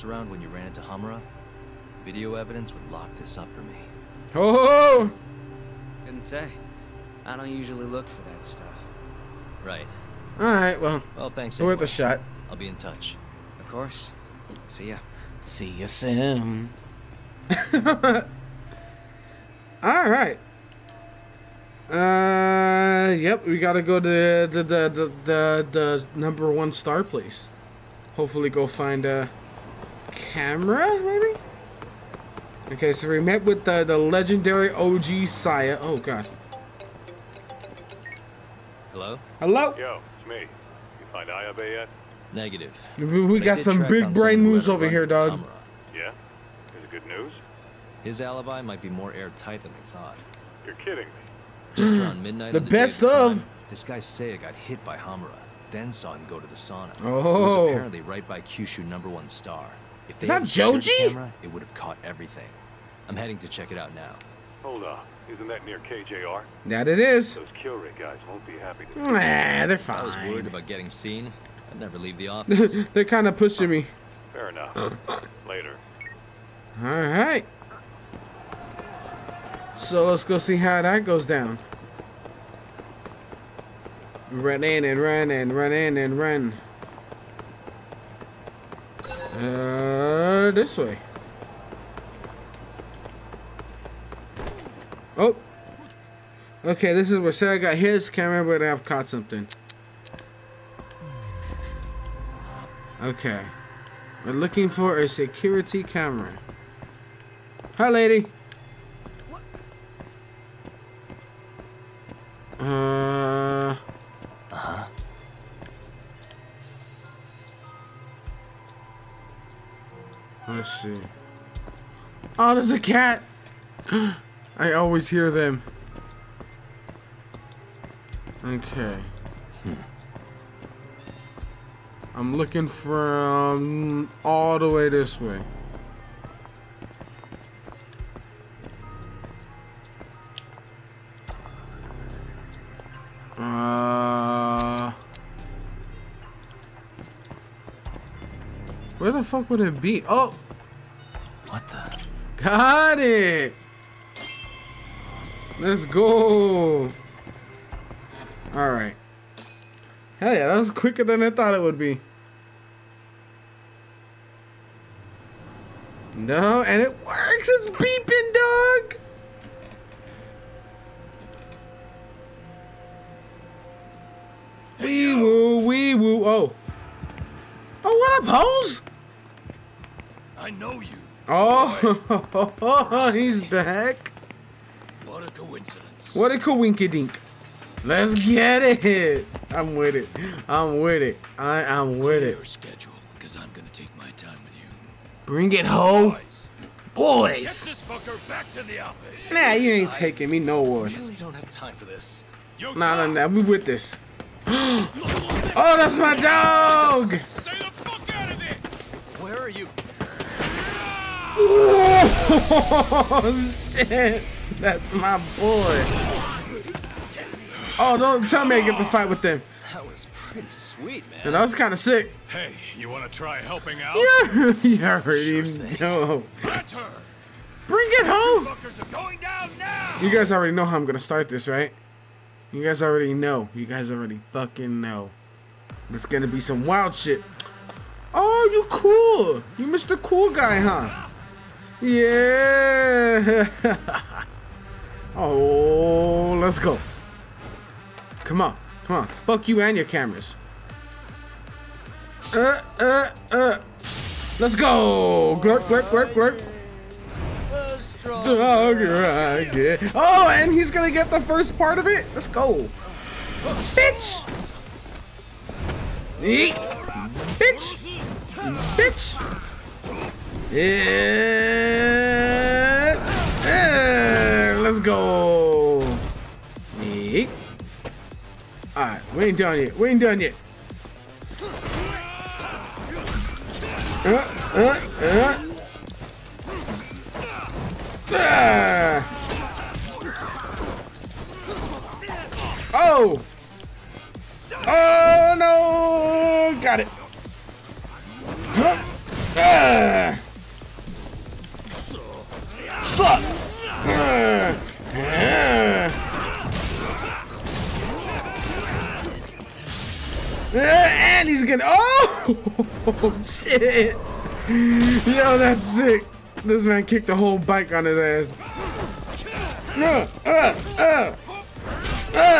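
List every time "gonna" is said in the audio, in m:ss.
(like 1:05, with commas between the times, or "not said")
3:13, 3:50, 3:56, 4:20, 5:11.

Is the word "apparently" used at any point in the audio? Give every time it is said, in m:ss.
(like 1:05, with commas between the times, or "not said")
0:57.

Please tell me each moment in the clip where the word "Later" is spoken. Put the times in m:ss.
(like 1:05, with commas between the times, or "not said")
1:15.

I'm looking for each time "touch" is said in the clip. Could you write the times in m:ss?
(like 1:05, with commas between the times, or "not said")
0:12.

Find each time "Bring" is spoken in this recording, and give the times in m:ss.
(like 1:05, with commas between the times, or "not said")
3:15, 3:47.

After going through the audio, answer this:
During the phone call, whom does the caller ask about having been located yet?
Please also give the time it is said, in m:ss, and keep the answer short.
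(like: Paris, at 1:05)
Ayabe, at 0:40.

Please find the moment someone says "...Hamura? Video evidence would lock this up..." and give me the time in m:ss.
0:00.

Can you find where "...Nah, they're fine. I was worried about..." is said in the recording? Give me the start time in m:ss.
1:09.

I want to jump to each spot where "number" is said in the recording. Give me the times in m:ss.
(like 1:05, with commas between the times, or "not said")
0:26, 0:58.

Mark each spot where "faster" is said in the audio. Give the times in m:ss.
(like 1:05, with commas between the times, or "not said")
not said.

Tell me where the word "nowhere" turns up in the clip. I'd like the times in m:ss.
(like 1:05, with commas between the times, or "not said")
3:20.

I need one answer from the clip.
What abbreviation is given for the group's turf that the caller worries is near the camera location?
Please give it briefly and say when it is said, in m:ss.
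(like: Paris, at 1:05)
KJR, at 1:05.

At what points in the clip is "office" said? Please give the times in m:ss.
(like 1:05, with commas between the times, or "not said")
1:12, 3:18.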